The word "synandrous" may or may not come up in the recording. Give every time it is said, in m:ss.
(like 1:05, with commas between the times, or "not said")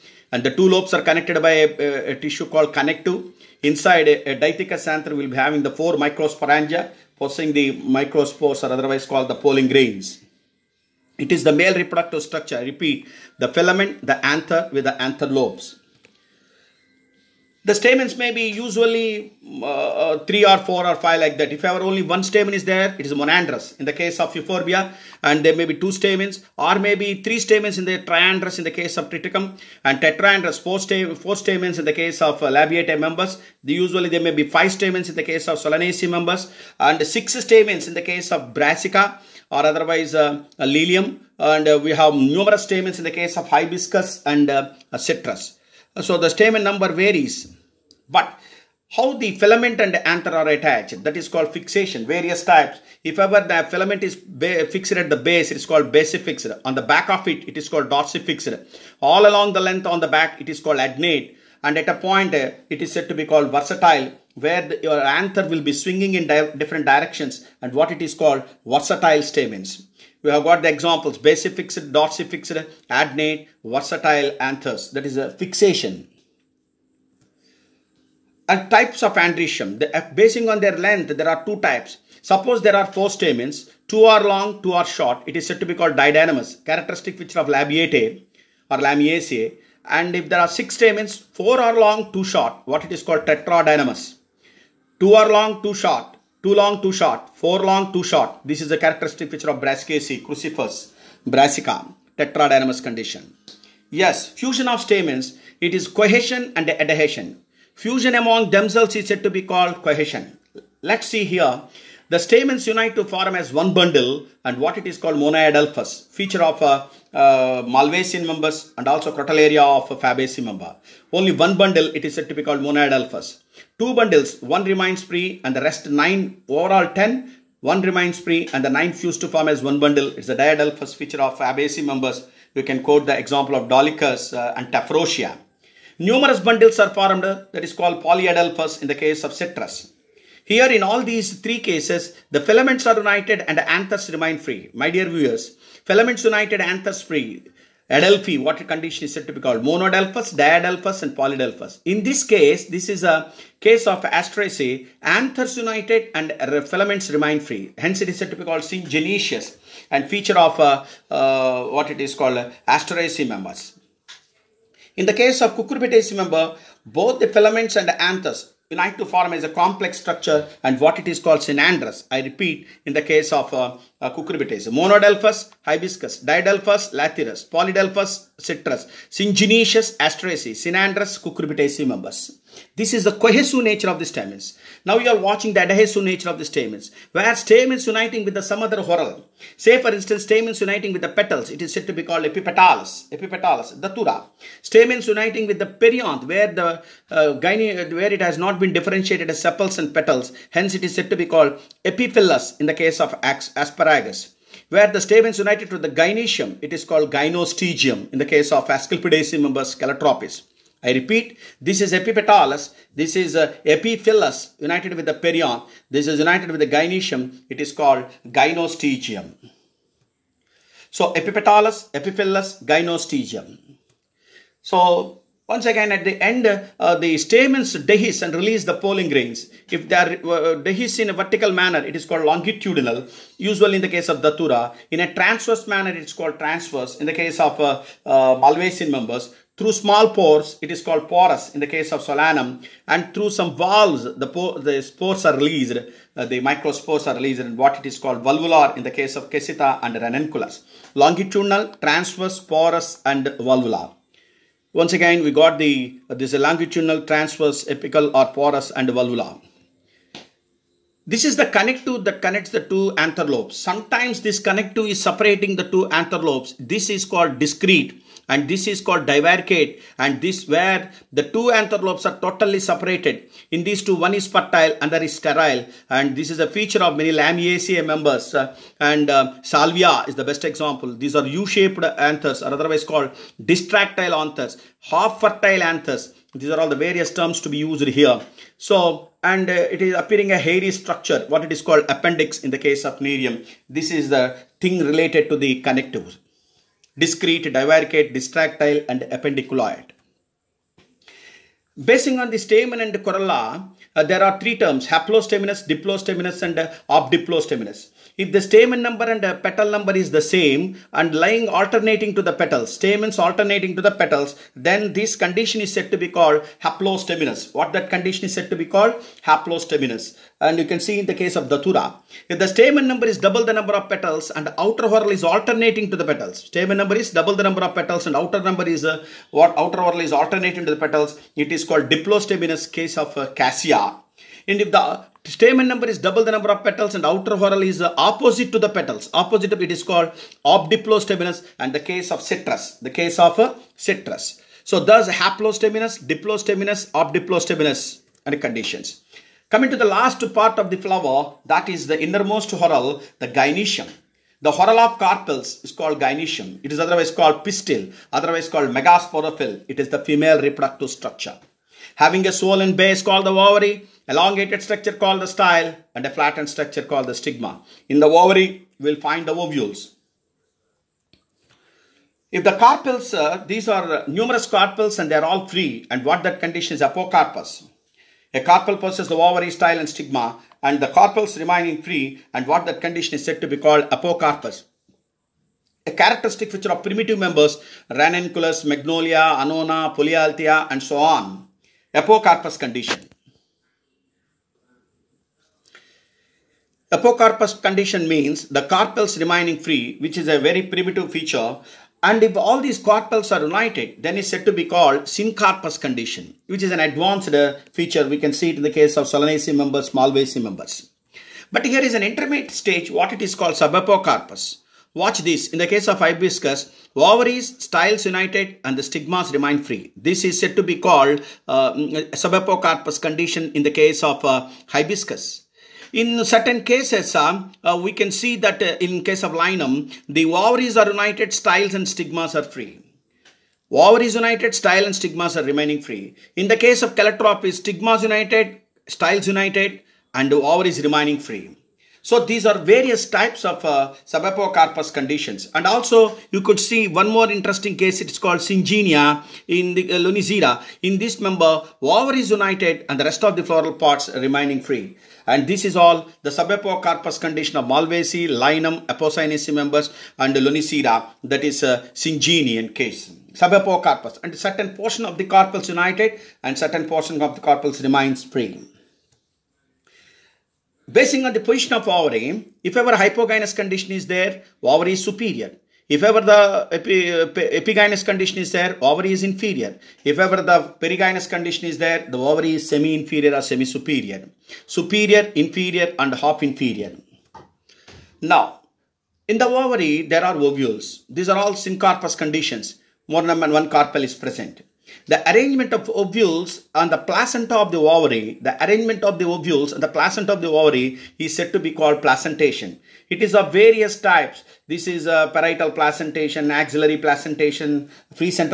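2:51, 3:00.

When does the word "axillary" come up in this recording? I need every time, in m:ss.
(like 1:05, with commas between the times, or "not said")
8:26.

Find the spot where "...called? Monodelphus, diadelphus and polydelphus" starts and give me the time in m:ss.
2:29.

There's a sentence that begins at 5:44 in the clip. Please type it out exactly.
So thus haplostaminous, diplostaminous, obdiplostaminous and conditions.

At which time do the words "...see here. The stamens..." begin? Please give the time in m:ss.
1:51.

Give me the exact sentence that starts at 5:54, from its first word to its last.
The whorl of carpels is called gynoecium.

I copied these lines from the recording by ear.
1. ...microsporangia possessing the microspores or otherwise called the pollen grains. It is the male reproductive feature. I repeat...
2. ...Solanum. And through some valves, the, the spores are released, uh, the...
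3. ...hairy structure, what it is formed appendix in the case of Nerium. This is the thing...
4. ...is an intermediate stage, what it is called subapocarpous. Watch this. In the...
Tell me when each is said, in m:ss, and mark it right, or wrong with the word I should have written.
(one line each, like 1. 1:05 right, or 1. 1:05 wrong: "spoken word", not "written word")
1. 0:05 wrong: "structure", not "feature"
2. 4:02 right
3. 4:50 wrong: "called", not "formed"
4. 6:51 right.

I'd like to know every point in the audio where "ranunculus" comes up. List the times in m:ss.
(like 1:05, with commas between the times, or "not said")
4:09, 6:27.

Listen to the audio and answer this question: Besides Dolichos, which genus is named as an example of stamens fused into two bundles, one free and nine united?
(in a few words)
Tephrosia.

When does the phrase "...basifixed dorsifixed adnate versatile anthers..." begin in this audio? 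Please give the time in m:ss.
1:11.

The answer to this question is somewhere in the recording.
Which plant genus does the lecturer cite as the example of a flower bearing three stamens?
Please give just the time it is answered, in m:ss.
0:29.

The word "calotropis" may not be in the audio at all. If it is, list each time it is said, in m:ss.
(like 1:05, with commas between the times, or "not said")
3:29, 7:16.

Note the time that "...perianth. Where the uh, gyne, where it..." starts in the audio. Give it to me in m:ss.
3:15.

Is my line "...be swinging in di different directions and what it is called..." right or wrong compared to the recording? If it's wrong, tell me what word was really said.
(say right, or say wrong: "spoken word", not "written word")
right.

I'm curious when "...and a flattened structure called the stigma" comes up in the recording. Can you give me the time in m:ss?
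6:05.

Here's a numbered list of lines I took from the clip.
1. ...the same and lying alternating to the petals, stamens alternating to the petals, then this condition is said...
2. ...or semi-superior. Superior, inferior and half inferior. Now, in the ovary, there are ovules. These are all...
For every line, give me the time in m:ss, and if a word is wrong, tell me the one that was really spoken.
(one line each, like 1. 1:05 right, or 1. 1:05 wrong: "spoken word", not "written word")
1. 5:10 right
2. 8:03 right.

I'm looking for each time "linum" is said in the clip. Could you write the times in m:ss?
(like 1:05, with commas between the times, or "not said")
7:09, 7:38.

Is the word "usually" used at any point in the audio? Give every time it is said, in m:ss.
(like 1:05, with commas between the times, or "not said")
0:18, 0:33, 3:53.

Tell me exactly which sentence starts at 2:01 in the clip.
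Only one bundle it is said to be called monoadalphus.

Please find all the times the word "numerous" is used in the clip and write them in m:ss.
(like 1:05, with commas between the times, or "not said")
0:42, 2:15, 6:14.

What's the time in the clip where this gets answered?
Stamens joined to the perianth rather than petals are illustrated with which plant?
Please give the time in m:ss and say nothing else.
3:23.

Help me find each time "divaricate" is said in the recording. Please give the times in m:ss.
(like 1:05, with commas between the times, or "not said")
4:29, 4:57.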